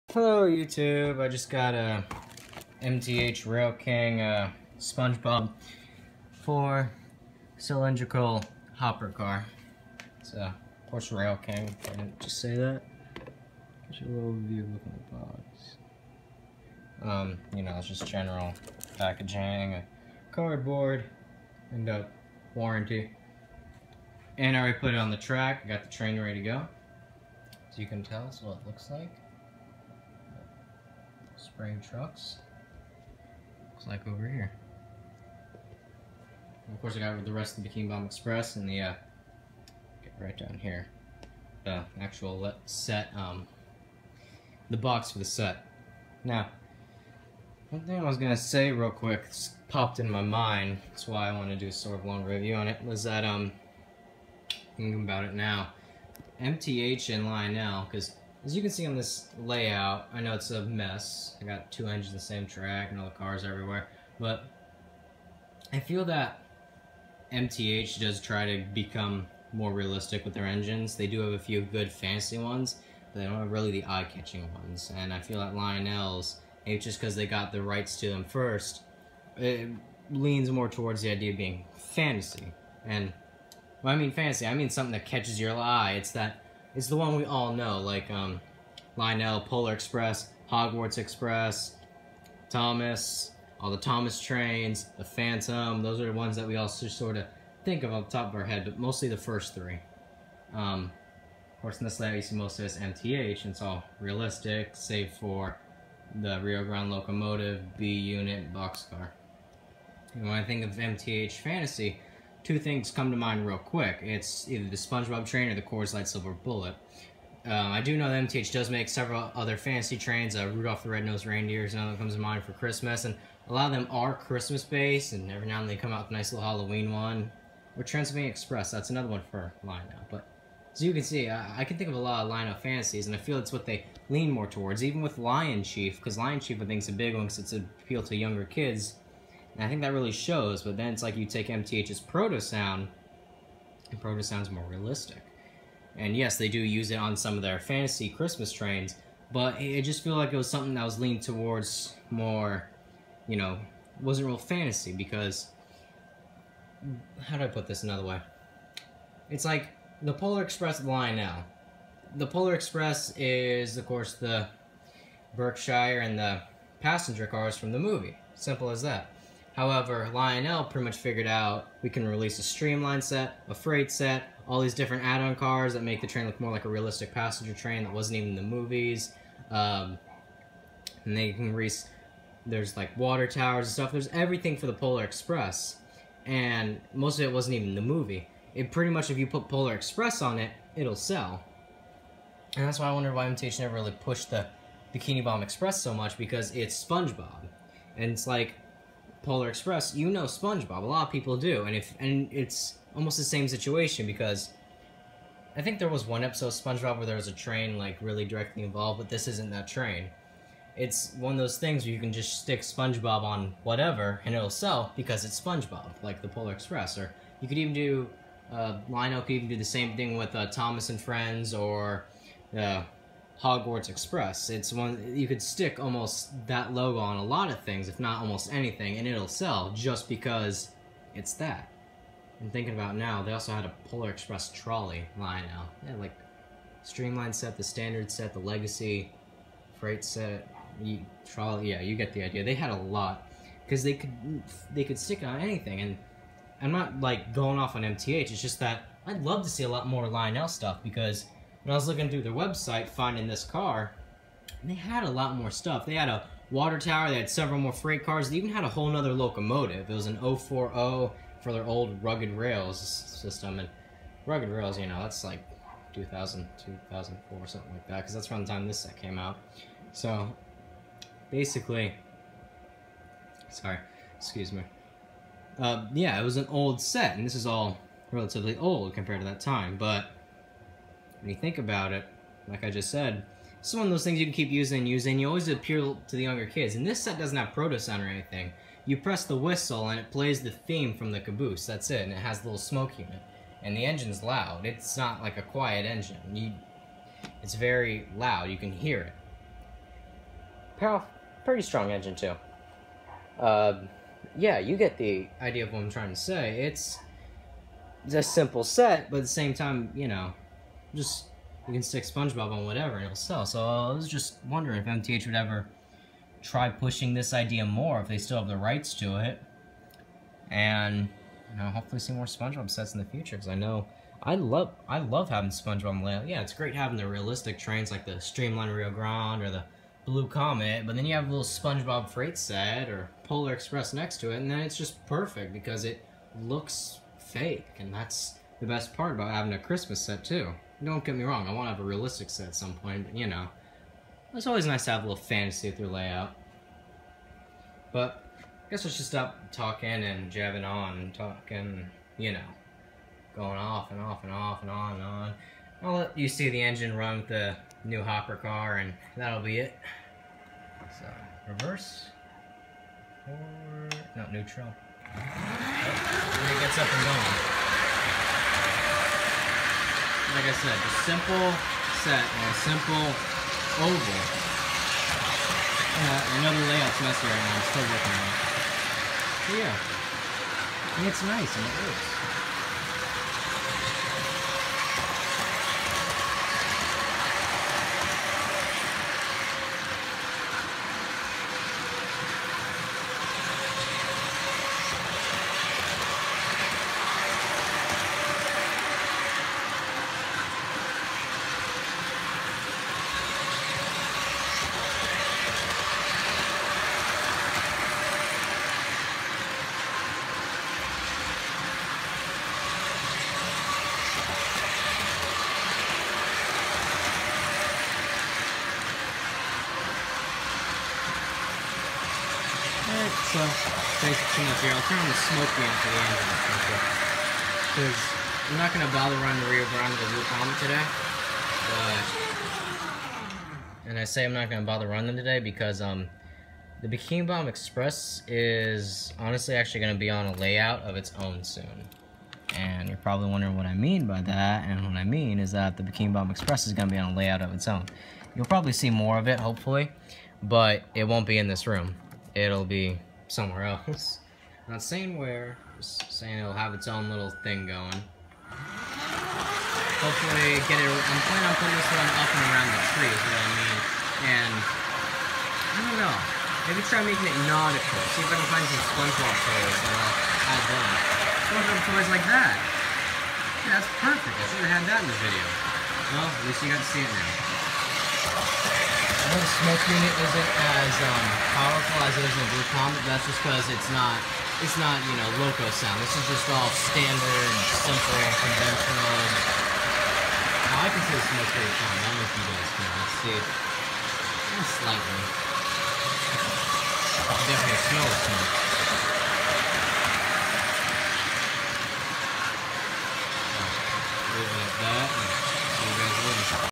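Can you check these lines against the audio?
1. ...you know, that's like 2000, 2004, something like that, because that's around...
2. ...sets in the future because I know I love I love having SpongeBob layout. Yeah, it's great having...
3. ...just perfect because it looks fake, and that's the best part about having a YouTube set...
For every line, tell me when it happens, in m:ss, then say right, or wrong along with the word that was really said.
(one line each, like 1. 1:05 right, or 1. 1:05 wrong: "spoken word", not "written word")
1. 4:24 right
2. 5:22 right
3. 5:34 wrong: "Christmas", not "YouTube".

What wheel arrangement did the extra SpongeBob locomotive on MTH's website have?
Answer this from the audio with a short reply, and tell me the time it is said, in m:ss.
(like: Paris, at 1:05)
0-4-0, at 4:20.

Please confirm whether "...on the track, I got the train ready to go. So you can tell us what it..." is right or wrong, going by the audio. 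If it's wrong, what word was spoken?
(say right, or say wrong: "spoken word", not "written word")
right.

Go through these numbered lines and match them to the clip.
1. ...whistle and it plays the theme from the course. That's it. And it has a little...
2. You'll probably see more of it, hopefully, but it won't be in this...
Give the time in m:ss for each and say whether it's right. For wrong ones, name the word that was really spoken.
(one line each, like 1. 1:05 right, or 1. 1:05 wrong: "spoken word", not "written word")
1. 4:49 wrong: "caboose", not "course"
2. 7:28 right.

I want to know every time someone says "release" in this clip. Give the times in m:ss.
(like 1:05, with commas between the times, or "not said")
2:52, 3:01.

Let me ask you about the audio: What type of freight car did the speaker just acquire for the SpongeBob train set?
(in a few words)
4 cylindrical hopper car.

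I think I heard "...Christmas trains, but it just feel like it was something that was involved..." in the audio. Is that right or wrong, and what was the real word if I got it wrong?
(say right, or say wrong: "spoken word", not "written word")
wrong: "leaned", not "involved".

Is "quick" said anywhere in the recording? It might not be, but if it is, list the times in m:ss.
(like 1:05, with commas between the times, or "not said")
0:48, 1:53.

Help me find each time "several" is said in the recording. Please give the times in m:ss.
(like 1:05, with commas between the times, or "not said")
1:58, 4:17.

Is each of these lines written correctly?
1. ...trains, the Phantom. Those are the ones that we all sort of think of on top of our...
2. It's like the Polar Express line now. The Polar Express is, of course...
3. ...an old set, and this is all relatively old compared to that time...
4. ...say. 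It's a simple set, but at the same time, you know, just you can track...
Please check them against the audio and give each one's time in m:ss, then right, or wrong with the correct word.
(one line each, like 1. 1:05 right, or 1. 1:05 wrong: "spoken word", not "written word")
1. 1:34 right
2. 2:39 right
3. 4:36 right
4. 5:06 wrong: "stick", not "track".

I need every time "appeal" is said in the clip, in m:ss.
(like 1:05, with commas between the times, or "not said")
2:17, 4:45.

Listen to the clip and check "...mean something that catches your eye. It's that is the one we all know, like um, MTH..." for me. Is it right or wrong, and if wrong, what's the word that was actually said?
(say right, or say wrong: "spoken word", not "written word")
wrong: "Lionel", not "MTH".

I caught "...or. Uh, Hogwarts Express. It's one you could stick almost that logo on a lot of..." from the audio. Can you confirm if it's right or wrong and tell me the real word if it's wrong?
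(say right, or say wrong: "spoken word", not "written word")
right.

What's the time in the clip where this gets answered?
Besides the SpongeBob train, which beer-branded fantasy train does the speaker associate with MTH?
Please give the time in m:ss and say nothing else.
1:55.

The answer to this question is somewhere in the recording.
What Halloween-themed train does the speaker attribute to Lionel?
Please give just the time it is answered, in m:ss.
2:07.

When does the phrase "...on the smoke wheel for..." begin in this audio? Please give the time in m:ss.
7:04.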